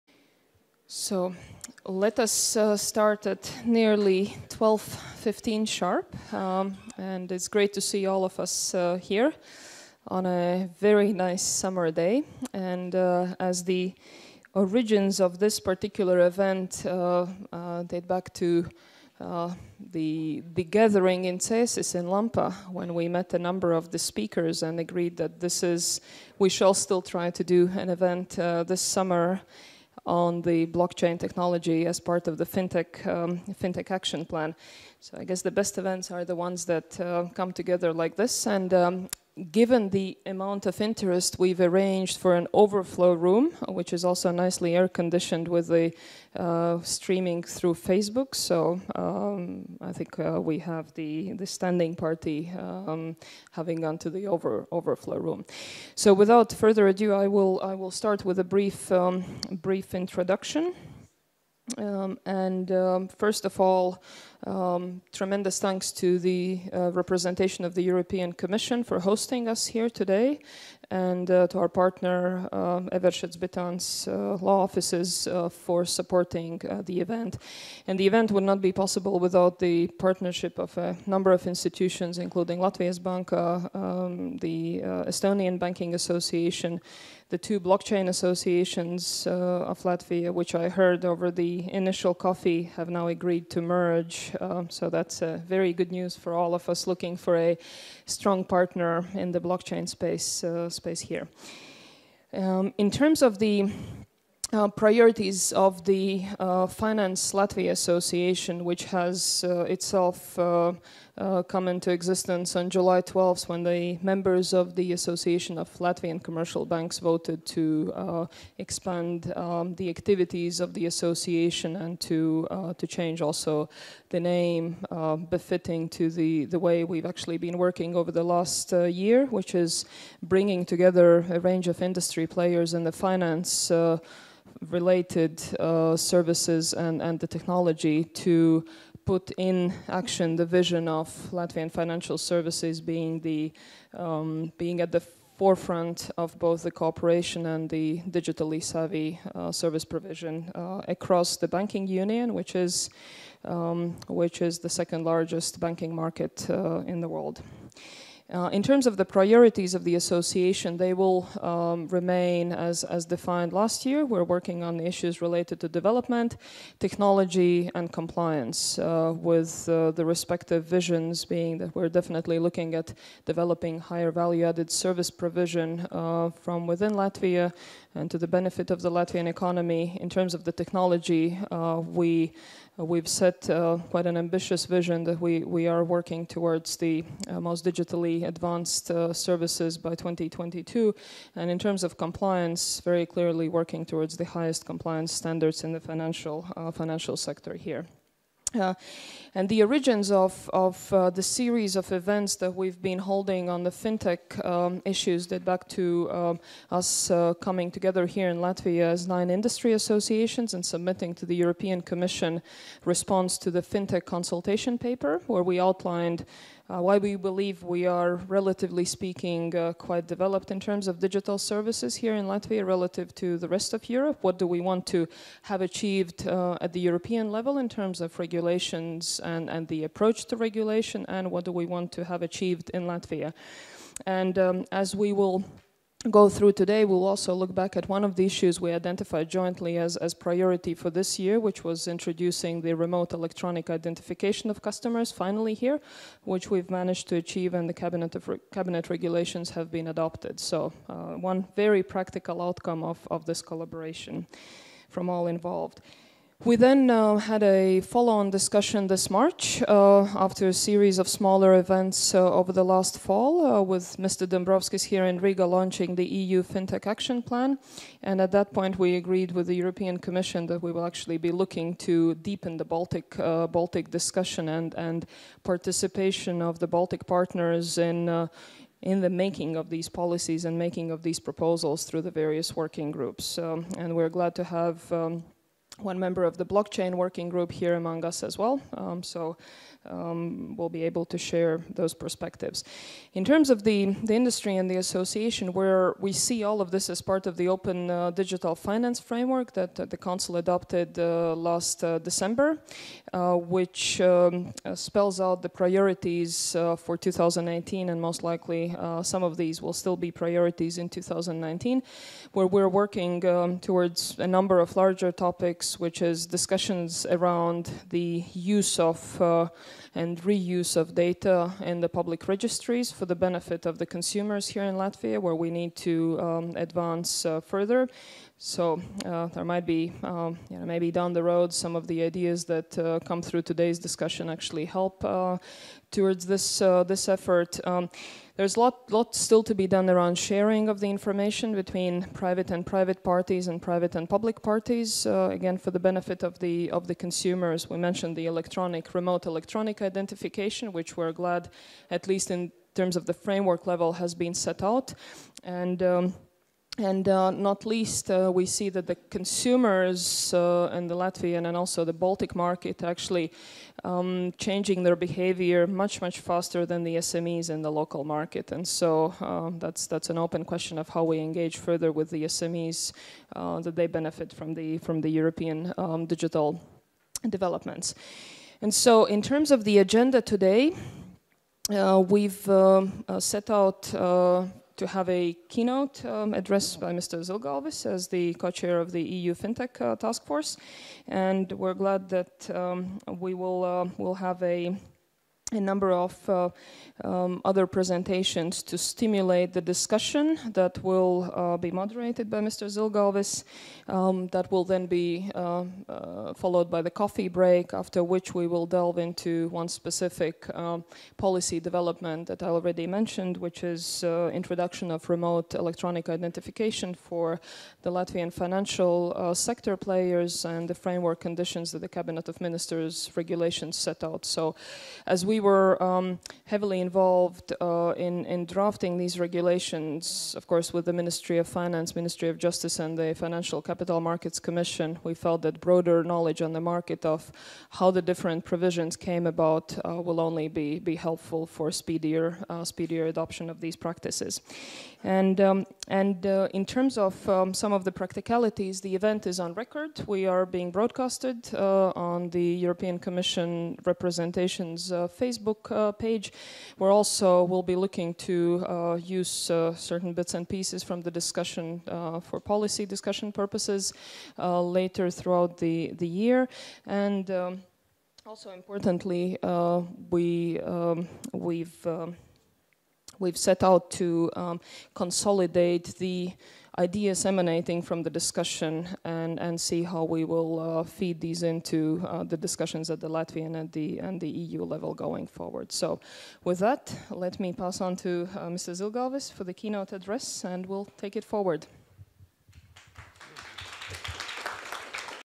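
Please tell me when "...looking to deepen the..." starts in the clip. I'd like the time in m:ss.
4:31.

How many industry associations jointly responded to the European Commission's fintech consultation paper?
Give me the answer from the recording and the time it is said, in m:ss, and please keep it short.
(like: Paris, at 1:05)
nine, at 3:29.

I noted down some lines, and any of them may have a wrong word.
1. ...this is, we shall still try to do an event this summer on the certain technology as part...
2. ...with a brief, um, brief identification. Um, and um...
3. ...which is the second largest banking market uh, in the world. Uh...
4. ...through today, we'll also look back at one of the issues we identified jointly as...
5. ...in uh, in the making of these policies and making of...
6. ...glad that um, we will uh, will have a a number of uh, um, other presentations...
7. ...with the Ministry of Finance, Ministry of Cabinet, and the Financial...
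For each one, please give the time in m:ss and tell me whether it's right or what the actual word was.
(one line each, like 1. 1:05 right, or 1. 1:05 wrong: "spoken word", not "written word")
1. 0:25 wrong: "blockchain", not "certain"
2. 0:58 wrong: "introduction", not "identification"
3. 2:34 right
4. 3:56 right
5. 4:37 right
6. 6:31 right
7. 7:10 wrong: "Justice", not "Cabinet".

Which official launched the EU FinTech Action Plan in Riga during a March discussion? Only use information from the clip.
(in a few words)
Mr. Dombrovskis.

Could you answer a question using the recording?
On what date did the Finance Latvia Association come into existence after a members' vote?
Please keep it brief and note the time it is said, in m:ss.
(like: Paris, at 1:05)
July 12th, at 1:52.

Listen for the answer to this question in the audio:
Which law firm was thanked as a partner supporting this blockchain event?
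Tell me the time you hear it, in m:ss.
1:12.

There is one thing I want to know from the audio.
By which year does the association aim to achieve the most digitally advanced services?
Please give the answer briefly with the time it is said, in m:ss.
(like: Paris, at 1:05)
2022, at 3:09.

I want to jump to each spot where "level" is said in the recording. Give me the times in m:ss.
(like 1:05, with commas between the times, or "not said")
3:47, 5:53, 8:04.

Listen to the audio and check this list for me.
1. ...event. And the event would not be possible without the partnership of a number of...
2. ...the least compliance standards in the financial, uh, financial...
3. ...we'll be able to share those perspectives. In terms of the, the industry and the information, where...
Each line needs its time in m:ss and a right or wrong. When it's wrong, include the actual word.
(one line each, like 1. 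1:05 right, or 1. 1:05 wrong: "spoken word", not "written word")
1. 1:16 right
2. 3:14 wrong: "highest", not "least"
3. 4:50 wrong: "association", not "information".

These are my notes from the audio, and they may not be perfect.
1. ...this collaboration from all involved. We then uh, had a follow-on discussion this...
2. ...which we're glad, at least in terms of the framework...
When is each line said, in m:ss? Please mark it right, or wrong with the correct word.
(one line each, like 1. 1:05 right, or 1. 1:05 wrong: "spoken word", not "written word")
1. 4:13 right
2. 5:50 right.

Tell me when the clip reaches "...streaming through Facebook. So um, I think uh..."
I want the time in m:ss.
0:46.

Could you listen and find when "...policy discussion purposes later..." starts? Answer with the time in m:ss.
7:42.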